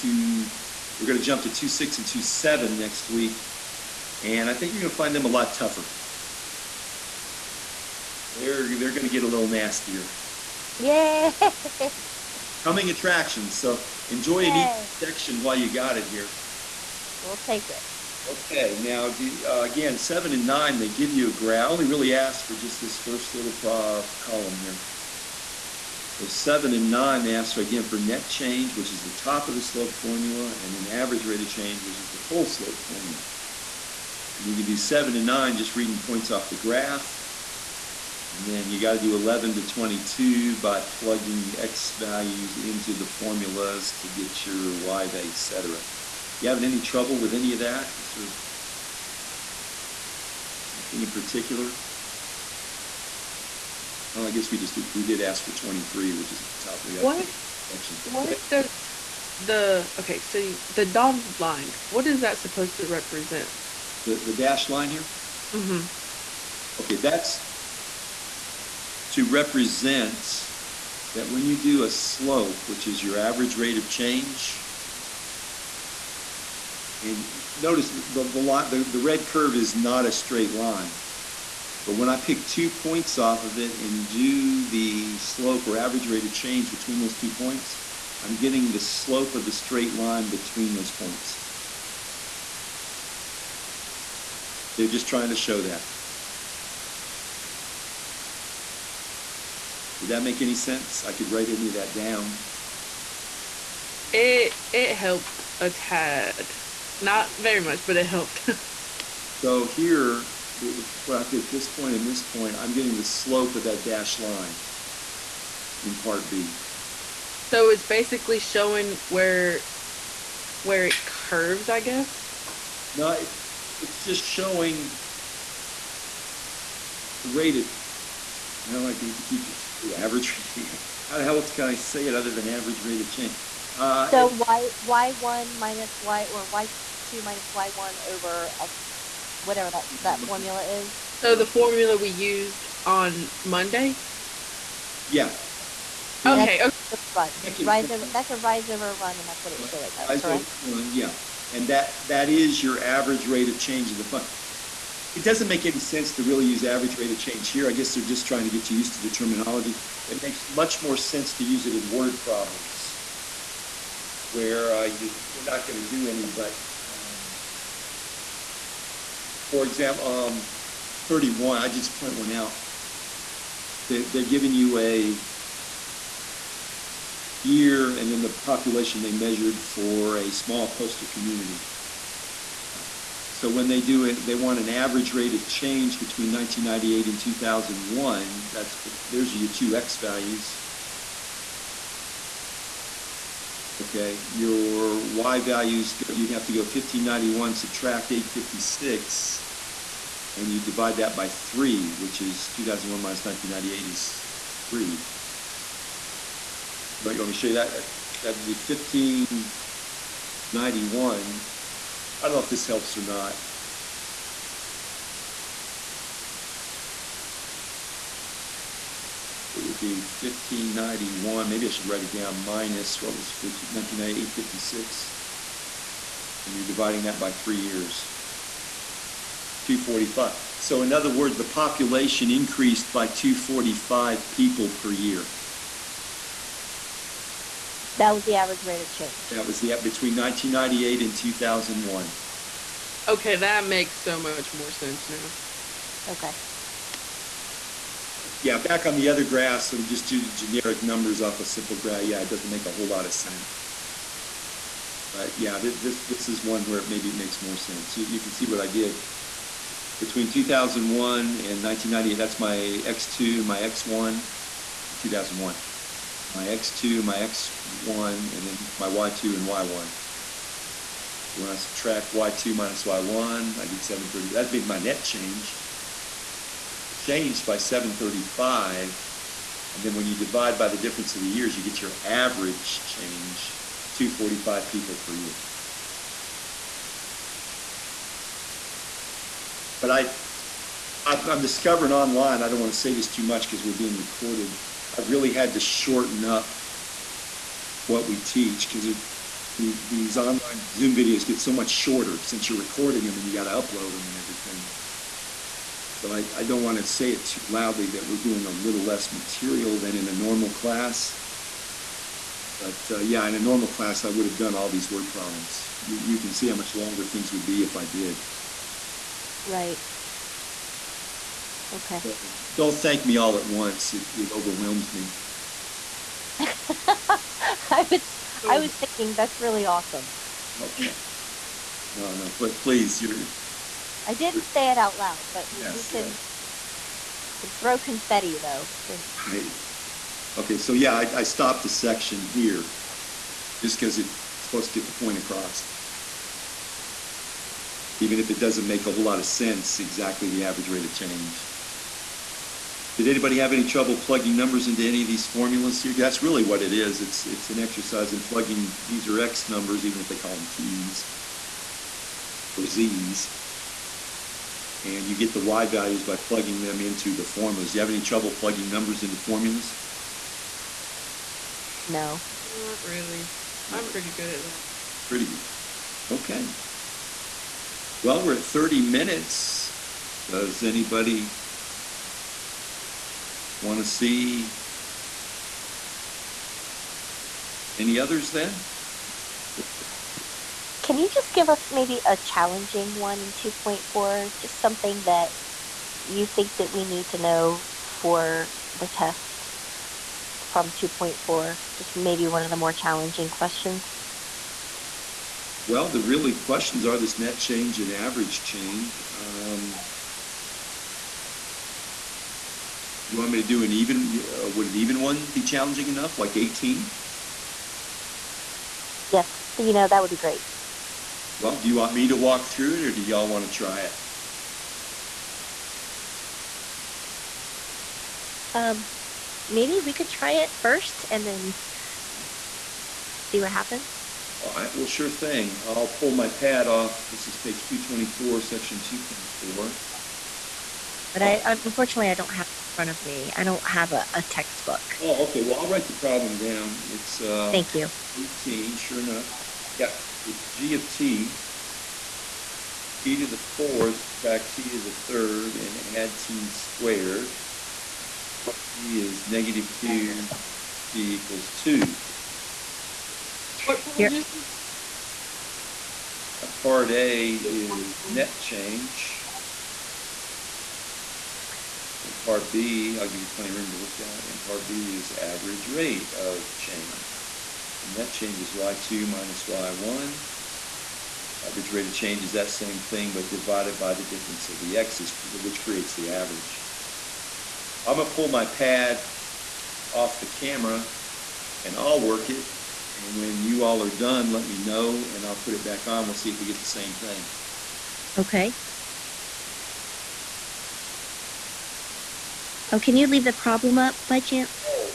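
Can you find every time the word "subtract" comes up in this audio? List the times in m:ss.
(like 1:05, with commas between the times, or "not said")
3:17, 4:31, 7:34.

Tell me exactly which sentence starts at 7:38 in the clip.
t is negative 2, t equals 2.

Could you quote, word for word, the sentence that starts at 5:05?
So I, I, don't want to say it too loudly that we're doing a little less material than in a normal class.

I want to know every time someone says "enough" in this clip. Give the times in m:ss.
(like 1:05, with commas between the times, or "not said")
6:55, 7:28.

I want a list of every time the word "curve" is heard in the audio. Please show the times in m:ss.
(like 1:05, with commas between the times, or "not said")
1:19, 2:01.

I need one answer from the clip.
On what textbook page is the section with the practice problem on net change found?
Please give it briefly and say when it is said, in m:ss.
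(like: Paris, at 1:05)
224, at 7:17.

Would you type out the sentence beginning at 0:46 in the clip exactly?
You having any trouble with any of that?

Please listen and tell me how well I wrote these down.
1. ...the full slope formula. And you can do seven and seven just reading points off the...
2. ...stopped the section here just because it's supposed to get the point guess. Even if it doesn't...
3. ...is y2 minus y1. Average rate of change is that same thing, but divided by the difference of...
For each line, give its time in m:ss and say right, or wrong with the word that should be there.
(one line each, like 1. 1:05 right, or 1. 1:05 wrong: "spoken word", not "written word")
1. 0:32 wrong: "nine", not "seven"
2. 5:41 wrong: "across", not "guess"
3. 7:58 right.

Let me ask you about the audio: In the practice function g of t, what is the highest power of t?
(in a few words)
fourth.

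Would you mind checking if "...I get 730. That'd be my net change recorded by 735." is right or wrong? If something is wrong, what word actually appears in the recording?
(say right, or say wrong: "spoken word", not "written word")
wrong: "changed", not "recorded".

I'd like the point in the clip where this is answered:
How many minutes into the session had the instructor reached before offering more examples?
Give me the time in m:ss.
6:18.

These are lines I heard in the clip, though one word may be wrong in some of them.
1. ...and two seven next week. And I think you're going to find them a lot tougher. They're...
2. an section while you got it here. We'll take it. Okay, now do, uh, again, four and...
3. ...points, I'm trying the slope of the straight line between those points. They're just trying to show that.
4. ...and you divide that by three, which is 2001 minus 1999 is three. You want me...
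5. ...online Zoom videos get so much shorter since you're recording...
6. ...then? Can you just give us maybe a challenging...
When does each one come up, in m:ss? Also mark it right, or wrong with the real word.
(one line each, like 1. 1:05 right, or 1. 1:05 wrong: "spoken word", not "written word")
1. 0:01 right
2. 0:14 wrong: "seven", not "four"
3. 1:27 wrong: "getting", not "trying"
4. 3:20 wrong: "1998", not "1999"
5. 5:00 right
6. 6:28 right.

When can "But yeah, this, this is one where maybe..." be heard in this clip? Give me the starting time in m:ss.
4:15.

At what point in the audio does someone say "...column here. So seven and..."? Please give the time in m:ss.
0:24.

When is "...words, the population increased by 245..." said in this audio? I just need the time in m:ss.
3:51.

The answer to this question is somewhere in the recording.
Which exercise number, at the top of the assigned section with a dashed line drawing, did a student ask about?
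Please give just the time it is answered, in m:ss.
0:55.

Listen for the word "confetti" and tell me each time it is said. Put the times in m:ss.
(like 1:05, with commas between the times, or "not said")
5:37.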